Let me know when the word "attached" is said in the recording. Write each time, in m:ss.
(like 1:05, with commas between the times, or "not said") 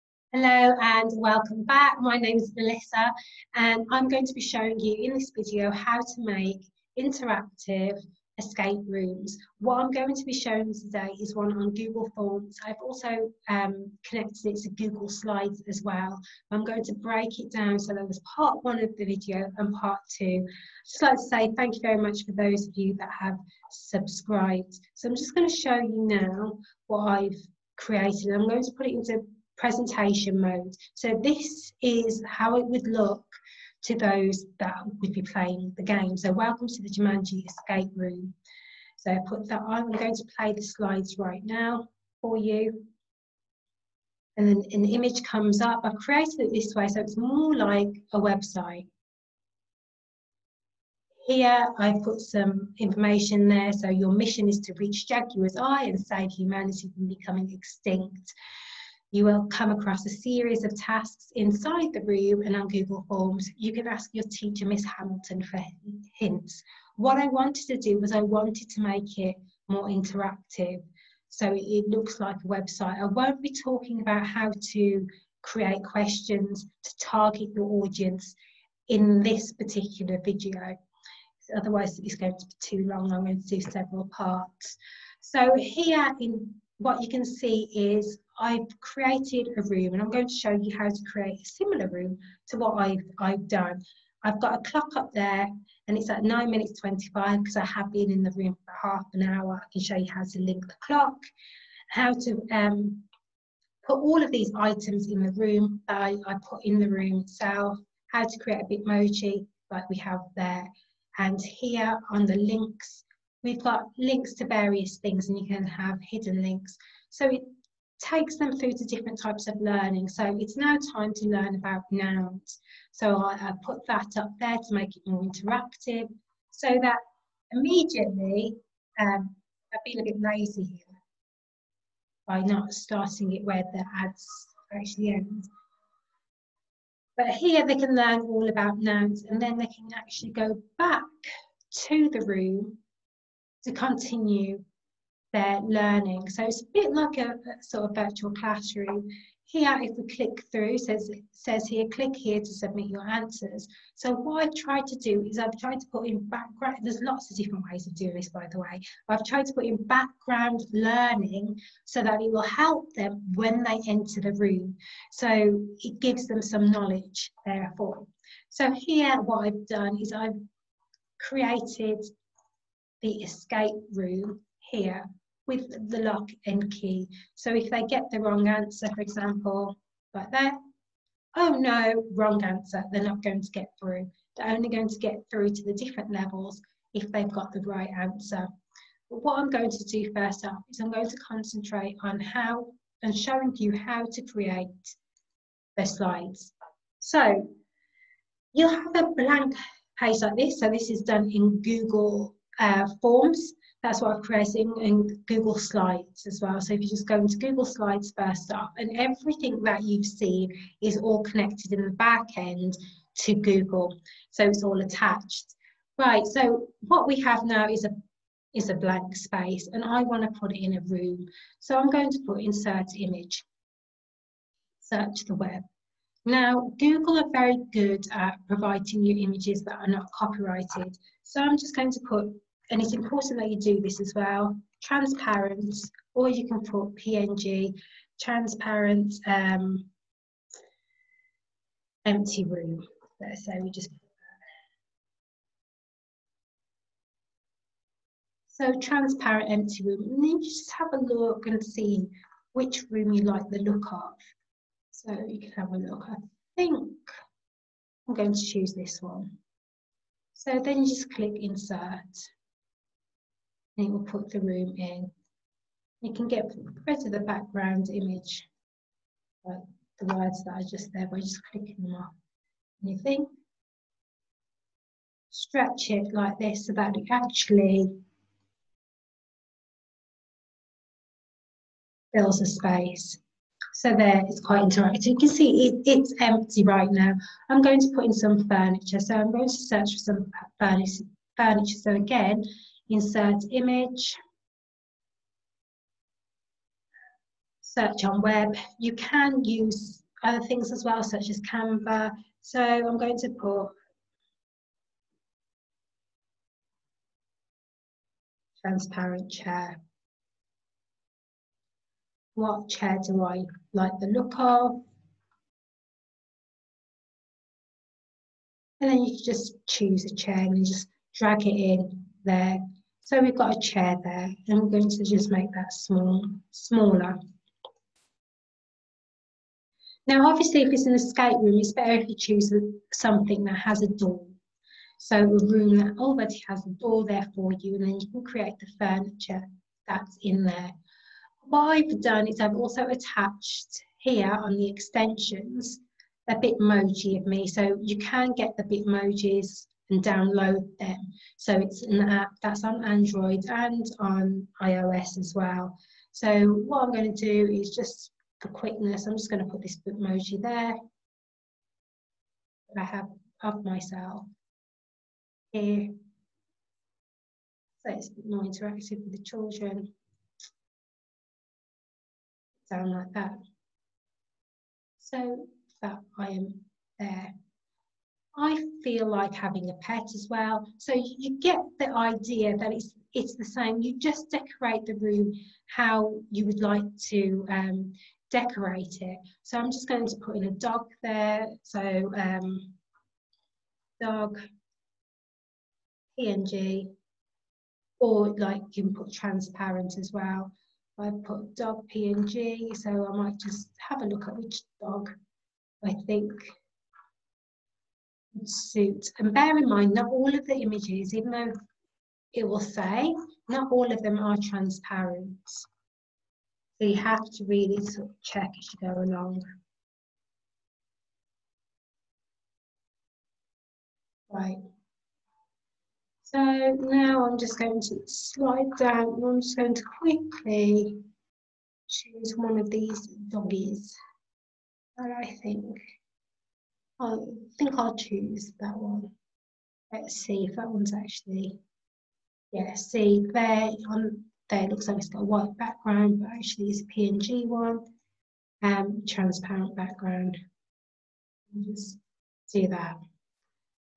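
3:34, 5:42.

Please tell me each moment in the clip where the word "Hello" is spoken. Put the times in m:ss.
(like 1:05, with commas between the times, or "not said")
0:00.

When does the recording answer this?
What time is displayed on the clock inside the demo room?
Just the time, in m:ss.
1:36.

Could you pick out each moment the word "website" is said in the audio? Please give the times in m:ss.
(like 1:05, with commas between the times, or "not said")
0:48, 1:12.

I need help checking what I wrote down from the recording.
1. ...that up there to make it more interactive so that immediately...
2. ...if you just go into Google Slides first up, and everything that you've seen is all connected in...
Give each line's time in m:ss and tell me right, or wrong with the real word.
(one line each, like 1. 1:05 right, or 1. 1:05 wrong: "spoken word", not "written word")
1. 2:03 right
2. 3:26 right.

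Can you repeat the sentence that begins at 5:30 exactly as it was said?
Now, obviously, if it's an escape room, it's better if you choose something that has a door.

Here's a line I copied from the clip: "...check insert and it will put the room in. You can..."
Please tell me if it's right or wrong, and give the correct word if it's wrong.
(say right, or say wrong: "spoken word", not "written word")
wrong: "click", not "check".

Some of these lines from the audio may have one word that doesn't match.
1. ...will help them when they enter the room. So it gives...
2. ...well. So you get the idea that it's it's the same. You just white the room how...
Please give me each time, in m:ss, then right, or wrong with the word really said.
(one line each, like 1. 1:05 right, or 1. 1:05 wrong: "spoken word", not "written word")
1. 2:42 right
2. 6:20 wrong: "decorate", not "white".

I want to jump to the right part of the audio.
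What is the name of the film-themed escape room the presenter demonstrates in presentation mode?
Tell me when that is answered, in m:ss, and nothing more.
0:36.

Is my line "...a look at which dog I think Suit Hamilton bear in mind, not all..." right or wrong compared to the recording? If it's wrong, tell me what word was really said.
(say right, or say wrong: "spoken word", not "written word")
wrong: "And", not "Hamilton".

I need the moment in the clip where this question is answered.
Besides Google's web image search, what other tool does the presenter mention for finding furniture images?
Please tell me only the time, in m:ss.
5:01.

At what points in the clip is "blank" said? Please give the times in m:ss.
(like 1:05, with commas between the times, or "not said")
3:19, 3:38.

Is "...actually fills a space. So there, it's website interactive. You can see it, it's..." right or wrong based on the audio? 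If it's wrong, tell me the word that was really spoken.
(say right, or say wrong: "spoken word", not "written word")
wrong: "quite", not "website".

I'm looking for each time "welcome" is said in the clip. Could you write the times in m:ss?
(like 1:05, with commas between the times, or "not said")
0:01, 0:36.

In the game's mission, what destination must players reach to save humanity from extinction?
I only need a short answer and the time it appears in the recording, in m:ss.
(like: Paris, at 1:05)
Jaguar's Eye, at 0:55.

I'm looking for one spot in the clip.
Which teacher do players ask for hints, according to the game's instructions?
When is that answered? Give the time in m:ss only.
1:04.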